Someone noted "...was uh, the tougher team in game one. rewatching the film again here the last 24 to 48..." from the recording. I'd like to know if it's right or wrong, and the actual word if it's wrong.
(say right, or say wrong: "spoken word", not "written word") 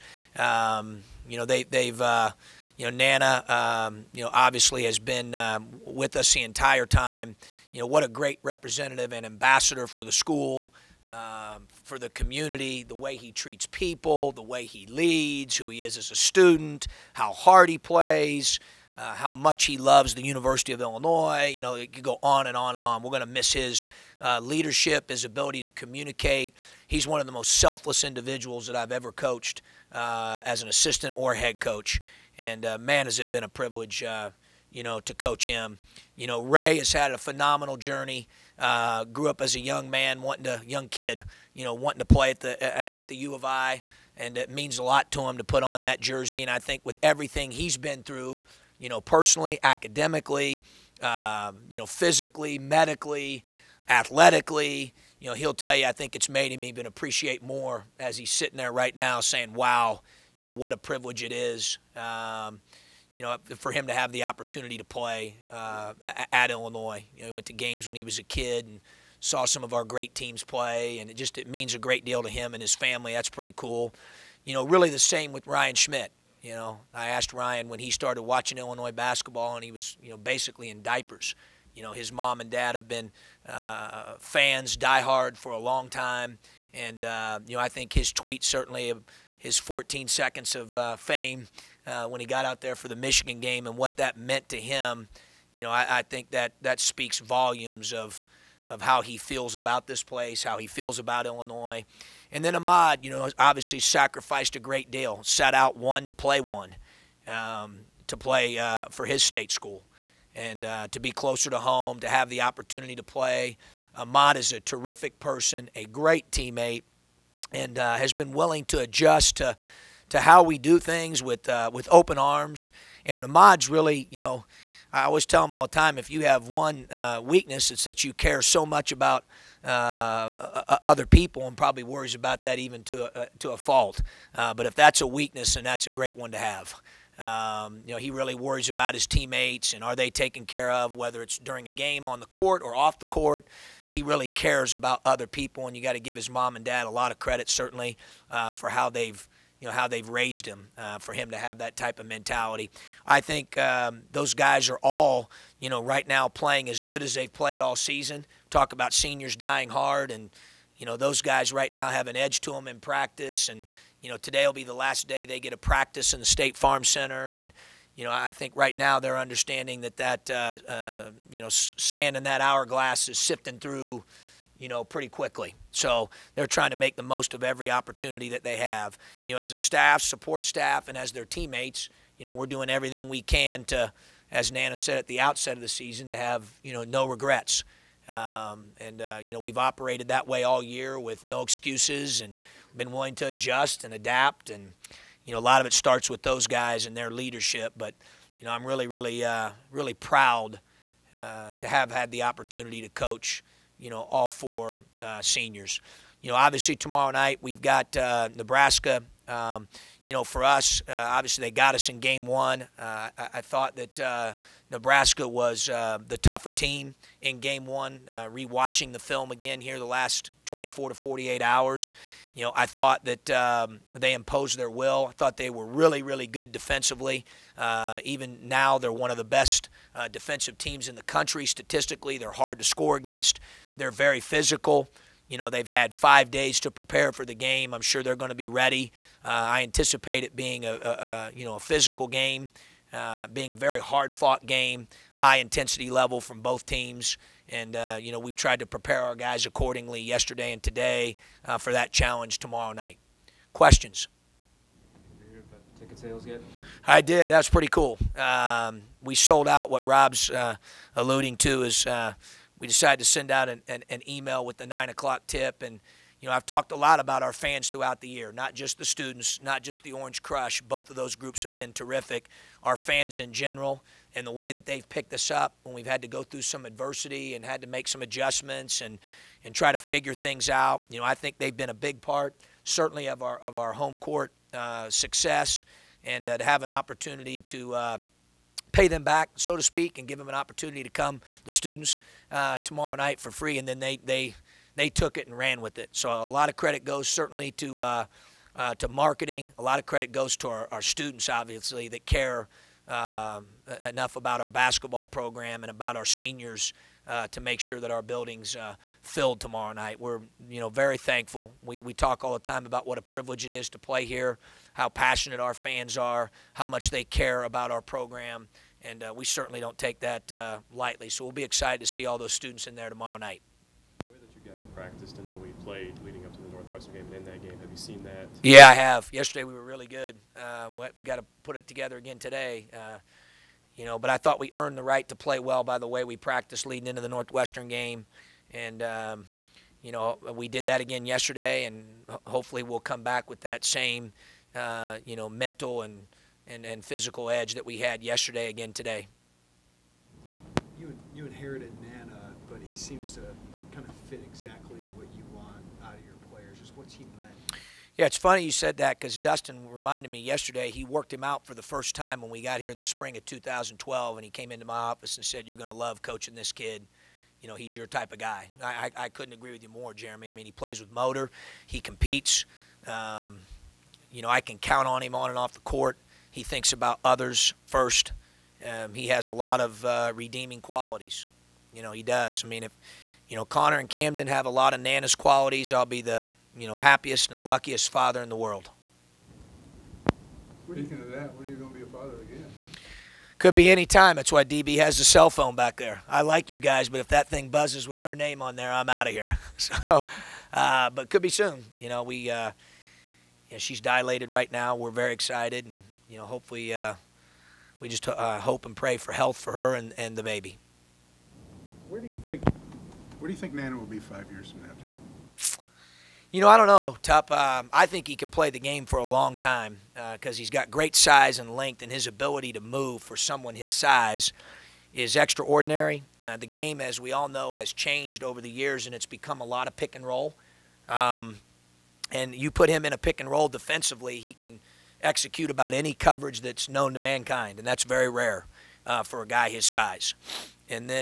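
right.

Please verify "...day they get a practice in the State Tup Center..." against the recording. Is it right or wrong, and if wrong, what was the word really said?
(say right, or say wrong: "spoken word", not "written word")
wrong: "Farm", not "Tup".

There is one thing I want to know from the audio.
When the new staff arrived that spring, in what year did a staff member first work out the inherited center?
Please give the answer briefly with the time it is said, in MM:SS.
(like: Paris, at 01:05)
2012, at 06:03.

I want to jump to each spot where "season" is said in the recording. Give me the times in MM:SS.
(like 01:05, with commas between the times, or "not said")
02:37, 03:05.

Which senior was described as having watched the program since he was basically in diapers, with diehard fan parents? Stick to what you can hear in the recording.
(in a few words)
Ryan Schmidt.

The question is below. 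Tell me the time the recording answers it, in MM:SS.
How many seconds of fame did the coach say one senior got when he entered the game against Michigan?
01:29.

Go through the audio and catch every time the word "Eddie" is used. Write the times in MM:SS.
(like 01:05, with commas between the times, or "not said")
not said.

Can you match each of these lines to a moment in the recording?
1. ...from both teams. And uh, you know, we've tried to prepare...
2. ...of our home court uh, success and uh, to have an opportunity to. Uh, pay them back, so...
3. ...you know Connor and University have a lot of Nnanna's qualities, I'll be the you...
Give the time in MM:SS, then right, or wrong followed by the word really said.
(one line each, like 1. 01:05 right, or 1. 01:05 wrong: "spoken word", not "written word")
1. 04:06 right
2. 04:43 right
3. 06:23 wrong: "Camden", not "University".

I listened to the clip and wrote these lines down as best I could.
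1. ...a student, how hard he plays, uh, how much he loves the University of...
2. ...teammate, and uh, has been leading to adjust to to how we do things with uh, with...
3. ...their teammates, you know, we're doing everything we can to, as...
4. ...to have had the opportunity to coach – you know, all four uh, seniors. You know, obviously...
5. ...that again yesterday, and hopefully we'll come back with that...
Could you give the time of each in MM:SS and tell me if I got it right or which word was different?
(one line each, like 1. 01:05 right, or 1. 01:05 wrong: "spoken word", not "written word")
1. 00:16 right
2. 01:56 wrong: "willing", not "leading"
3. 03:01 right
4. 03:21 right
5. 05:40 right.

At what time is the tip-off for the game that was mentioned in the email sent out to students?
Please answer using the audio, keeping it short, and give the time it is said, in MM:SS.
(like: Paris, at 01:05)
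9 o'clock, at 04:24.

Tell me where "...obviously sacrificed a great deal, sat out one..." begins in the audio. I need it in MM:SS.
01:43.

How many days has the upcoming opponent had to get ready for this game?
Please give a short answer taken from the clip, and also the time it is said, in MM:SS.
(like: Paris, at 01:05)
5, at 03:55.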